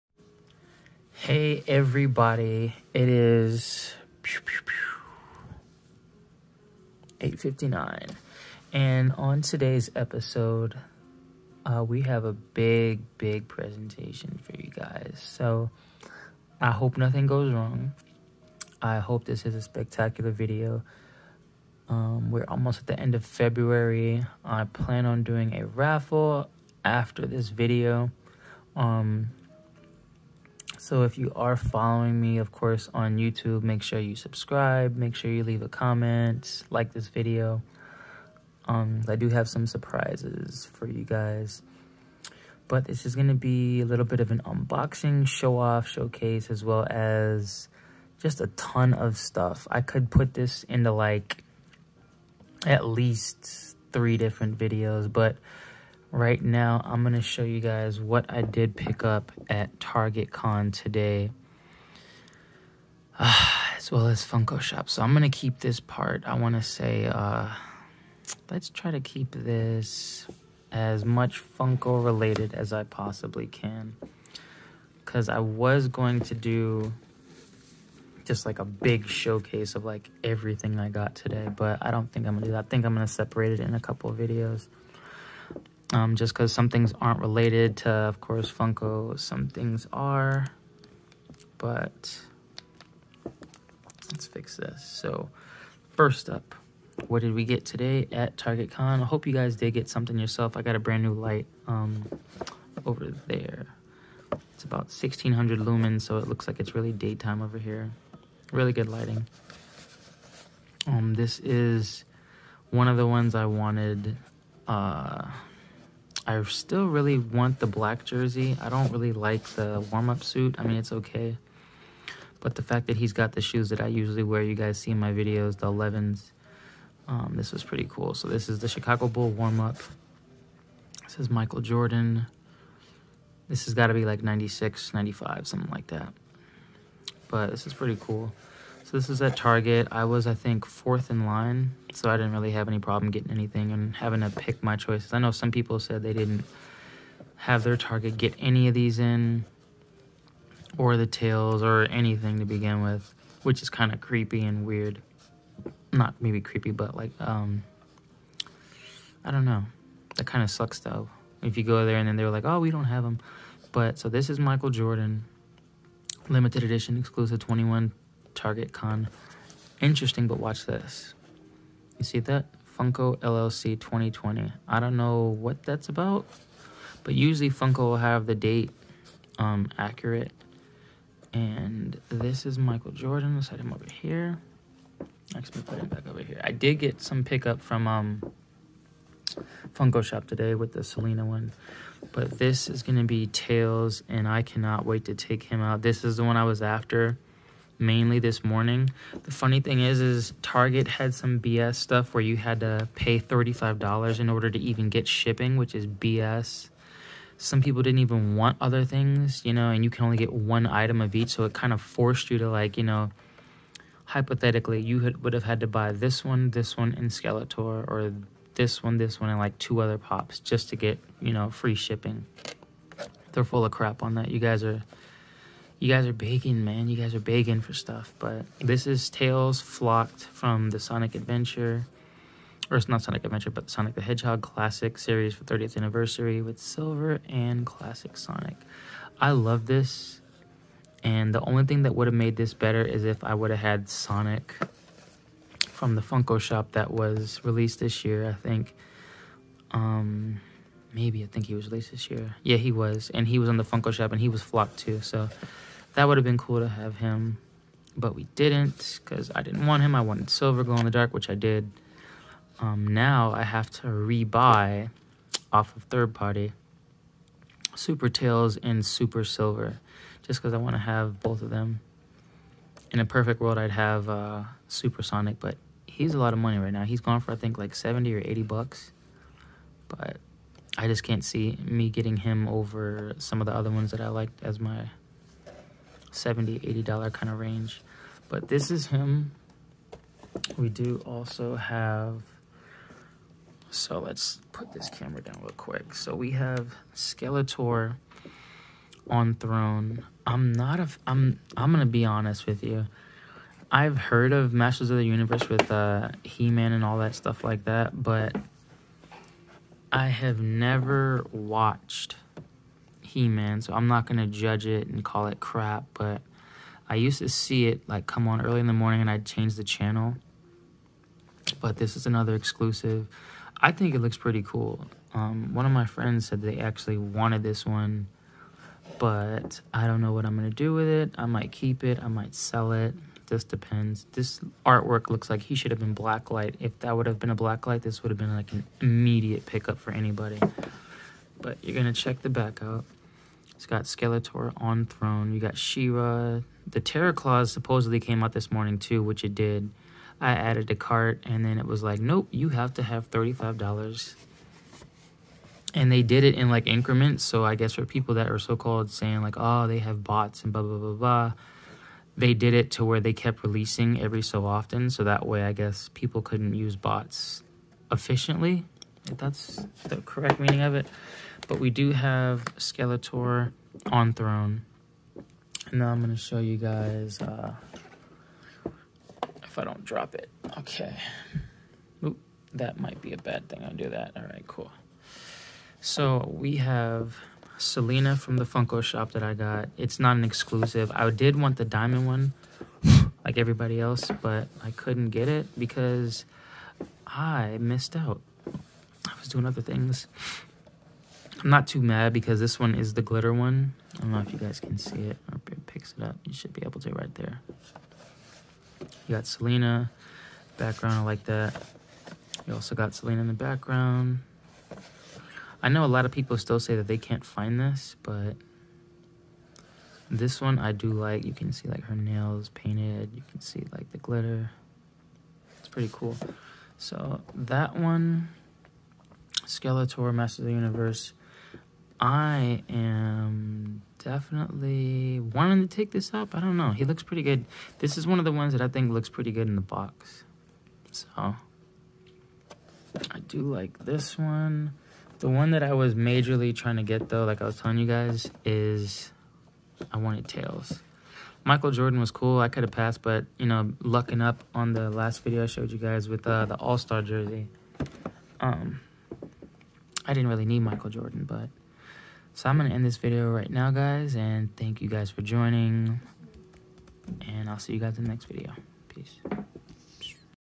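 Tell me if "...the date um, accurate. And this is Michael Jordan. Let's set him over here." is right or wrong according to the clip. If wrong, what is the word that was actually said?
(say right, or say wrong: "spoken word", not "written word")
right.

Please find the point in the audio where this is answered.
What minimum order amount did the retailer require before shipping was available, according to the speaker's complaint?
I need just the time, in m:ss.
3:23.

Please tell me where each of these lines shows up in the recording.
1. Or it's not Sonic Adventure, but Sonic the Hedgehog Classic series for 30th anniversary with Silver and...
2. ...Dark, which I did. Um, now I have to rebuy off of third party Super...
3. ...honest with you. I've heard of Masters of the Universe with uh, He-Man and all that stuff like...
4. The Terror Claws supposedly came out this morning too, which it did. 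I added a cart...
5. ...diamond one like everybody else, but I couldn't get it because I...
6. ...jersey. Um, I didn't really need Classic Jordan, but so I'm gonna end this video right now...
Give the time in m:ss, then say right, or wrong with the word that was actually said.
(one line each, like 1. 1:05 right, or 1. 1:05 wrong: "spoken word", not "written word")
1. 3:52 right
2. 4:20 right
3. 5:02 right
4. 5:46 right
5. 6:31 right
6. 7:37 wrong: "Michael", not "Classic".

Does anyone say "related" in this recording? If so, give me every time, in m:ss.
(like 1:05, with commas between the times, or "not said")
1:12, 1:27.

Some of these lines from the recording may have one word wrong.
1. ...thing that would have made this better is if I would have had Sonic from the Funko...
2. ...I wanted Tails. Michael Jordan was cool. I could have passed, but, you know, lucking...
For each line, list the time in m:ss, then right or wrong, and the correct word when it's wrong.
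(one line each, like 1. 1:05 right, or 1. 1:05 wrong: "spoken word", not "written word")
1. 4:01 right
2. 7:29 right.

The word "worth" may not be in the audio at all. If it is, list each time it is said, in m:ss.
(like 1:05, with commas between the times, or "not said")
not said.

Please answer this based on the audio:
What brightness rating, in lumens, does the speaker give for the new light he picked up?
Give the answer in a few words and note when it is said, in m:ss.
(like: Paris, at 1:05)
1600, at 1:44.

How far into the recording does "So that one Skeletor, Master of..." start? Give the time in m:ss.
7:06.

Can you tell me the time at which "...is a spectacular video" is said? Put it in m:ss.
0:19.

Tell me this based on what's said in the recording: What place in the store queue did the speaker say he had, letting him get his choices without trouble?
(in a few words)
fourth.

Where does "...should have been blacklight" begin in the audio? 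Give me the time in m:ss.
5:35.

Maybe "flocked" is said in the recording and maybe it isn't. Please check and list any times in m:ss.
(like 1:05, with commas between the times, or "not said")
3:49, 4:14.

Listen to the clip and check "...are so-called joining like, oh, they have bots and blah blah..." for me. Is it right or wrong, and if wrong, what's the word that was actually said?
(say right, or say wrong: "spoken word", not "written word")
wrong: "saying", not "joining".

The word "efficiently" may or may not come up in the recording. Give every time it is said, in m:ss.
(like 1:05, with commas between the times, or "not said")
6:07.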